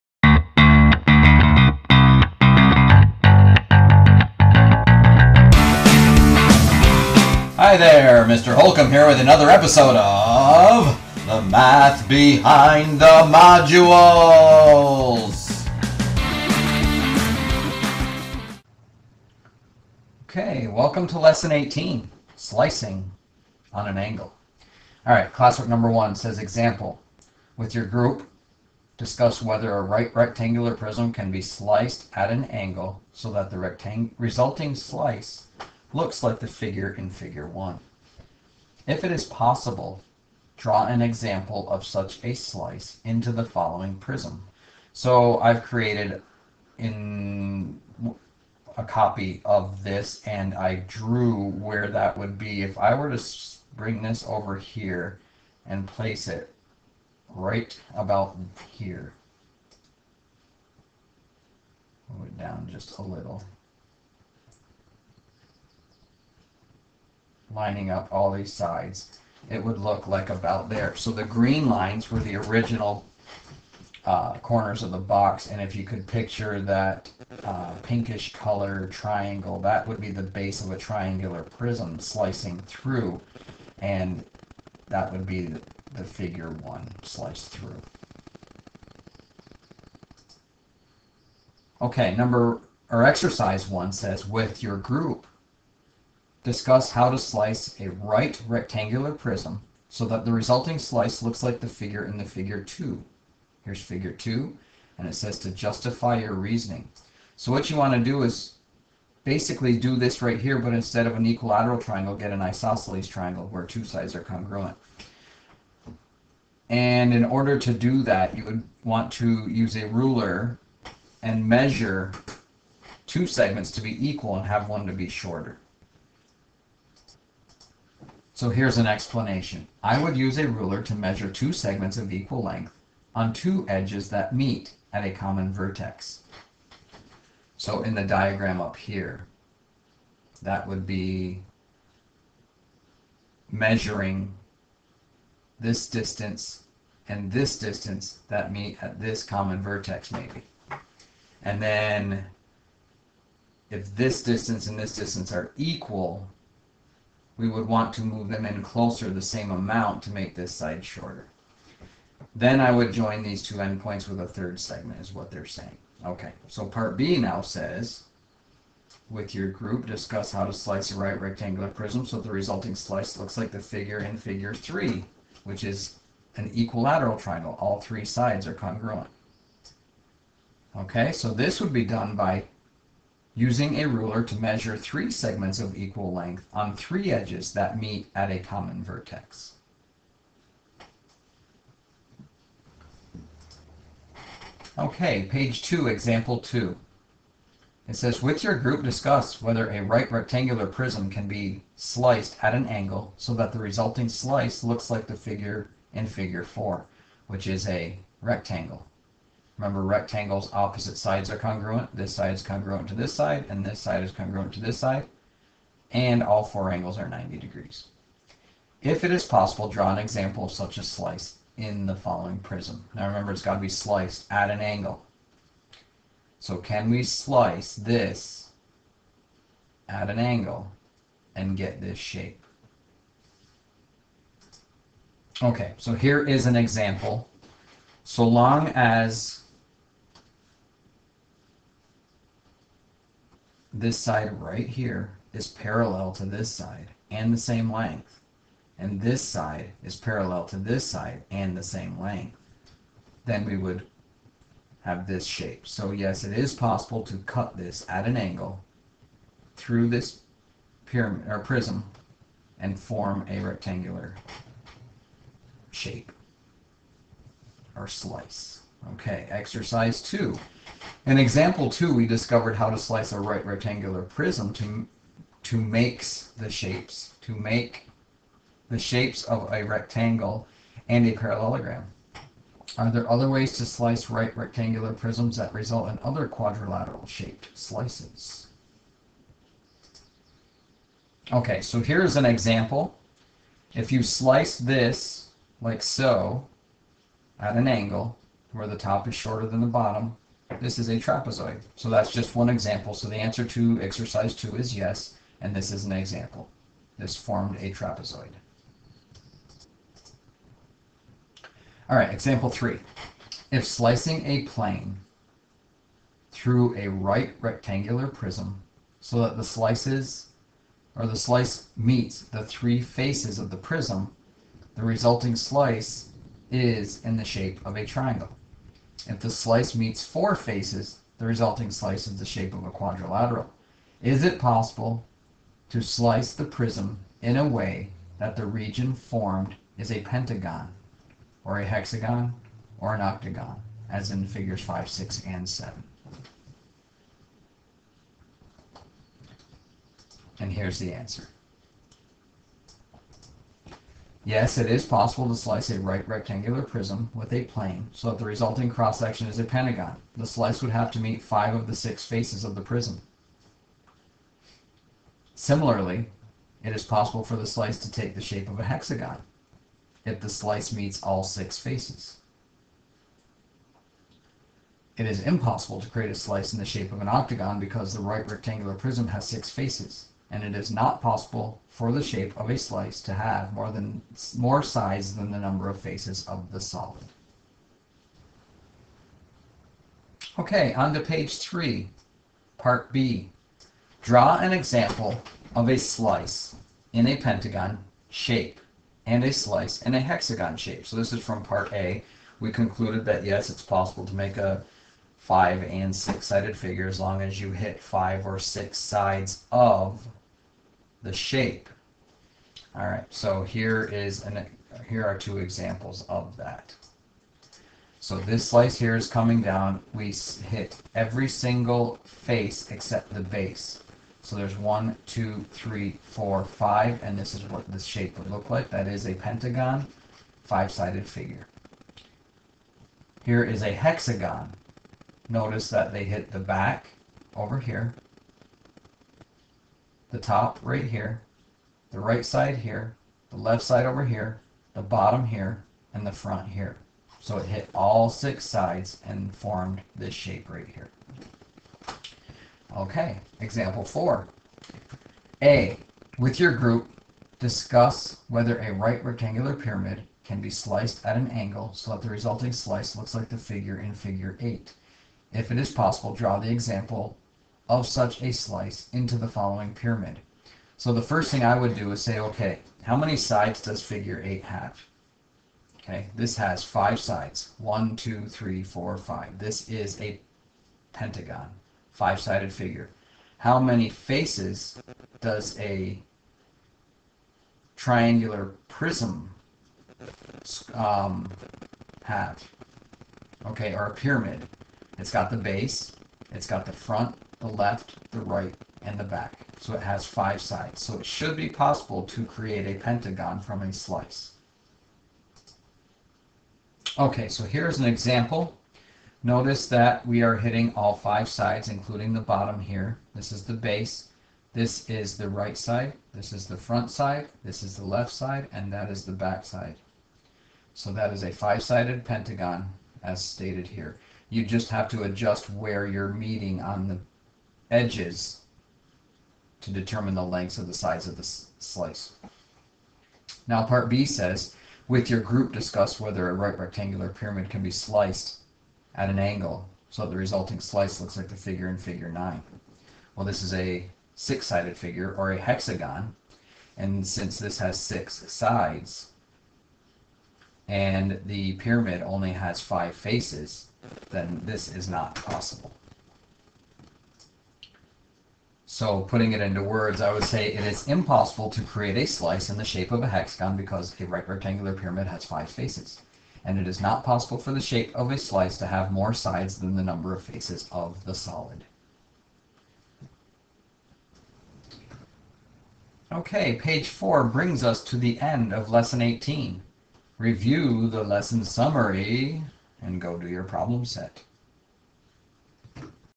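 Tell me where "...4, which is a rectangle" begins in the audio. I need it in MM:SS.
03:26.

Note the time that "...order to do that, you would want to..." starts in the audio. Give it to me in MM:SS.
01:57.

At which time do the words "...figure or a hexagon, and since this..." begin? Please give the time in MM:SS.
09:04.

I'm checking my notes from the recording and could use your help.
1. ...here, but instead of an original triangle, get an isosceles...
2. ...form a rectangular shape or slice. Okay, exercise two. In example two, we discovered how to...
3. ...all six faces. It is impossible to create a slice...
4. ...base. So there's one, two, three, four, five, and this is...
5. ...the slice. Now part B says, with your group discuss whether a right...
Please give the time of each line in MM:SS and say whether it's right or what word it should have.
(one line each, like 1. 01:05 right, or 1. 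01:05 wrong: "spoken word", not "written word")
1. 01:50 wrong: "equilateral", not "original"
2. 04:22 right
3. 06:11 right
4. 07:03 right
5. 08:51 right.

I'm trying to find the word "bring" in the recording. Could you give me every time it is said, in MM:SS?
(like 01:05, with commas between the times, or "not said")
00:53, 09:37.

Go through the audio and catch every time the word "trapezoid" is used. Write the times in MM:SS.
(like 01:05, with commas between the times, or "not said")
05:00, 05:07.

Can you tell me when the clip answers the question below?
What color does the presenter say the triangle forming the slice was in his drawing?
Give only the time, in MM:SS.
01:17.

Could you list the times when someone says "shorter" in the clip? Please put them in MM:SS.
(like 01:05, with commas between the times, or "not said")
02:05, 02:40, 04:59.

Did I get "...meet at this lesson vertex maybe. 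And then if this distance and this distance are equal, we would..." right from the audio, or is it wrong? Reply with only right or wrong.
wrong.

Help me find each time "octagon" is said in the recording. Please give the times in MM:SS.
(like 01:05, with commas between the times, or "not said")
05:43, 06:17.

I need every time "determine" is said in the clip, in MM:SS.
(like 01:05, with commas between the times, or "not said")
08:49.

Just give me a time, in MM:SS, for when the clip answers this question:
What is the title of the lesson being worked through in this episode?
00:22.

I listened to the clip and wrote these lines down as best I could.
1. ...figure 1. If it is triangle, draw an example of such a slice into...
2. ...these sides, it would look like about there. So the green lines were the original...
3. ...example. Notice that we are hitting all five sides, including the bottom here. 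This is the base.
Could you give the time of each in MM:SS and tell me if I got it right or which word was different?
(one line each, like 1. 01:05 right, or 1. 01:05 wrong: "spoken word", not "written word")
1. 00:37 wrong: "possible", not "triangle"
2. 01:08 right
3. 08:27 right.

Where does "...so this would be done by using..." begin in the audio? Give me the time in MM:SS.
03:01.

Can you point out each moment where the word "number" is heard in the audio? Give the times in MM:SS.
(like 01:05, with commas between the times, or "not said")
00:25, 01:32, 06:25, 09:29.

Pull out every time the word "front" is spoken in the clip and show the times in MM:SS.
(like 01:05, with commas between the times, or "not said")
07:26, 08:16, 08:36.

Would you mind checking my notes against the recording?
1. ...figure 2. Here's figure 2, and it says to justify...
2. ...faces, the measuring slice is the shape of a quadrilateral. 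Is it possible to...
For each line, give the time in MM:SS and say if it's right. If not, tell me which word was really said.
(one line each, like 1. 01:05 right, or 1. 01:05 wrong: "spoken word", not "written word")
1. 01:42 right
2. 05:30 wrong: "resulting", not "measuring".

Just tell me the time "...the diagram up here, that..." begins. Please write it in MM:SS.
02:17.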